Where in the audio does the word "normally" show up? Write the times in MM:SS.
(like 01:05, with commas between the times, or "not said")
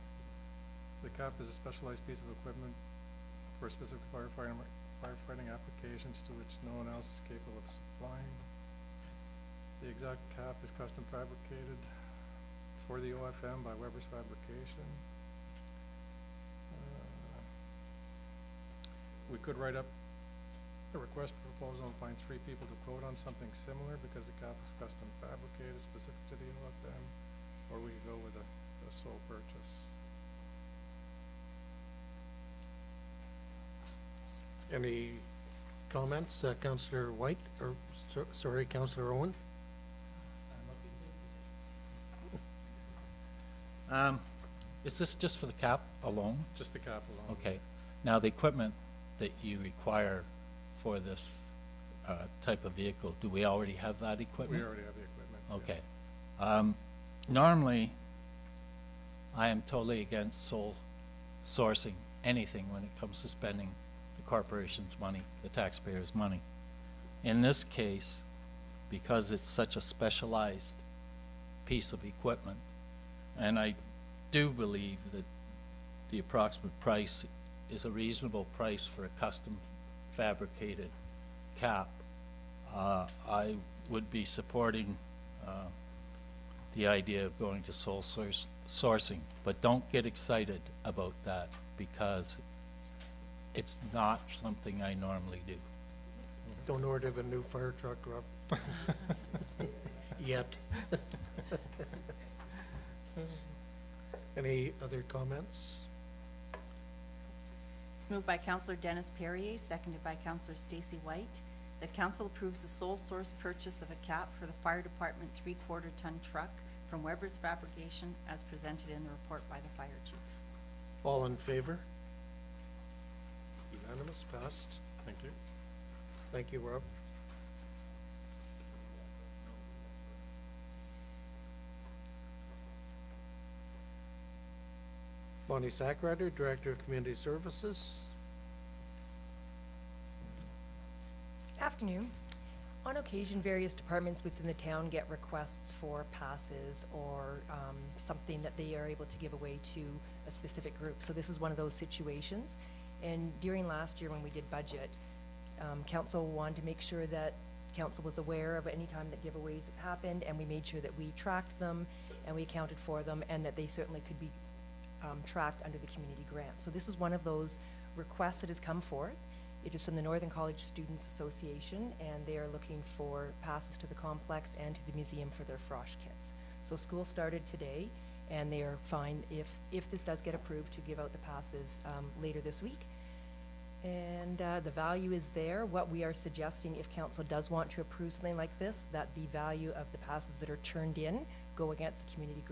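00:57, 01:34.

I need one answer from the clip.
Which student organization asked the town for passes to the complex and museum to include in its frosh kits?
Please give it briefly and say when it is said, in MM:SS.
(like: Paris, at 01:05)
Northern College Students Association, at 02:50.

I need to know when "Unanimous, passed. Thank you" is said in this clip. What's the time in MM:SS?
02:03.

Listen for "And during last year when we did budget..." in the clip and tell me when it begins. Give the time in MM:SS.
02:33.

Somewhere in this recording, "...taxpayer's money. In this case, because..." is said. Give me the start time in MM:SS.
01:05.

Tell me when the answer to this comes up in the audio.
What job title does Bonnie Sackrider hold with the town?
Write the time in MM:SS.
02:16.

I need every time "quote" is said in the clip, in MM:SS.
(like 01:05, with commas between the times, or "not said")
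00:22.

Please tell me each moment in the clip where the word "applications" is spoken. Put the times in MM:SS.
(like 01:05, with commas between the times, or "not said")
00:05.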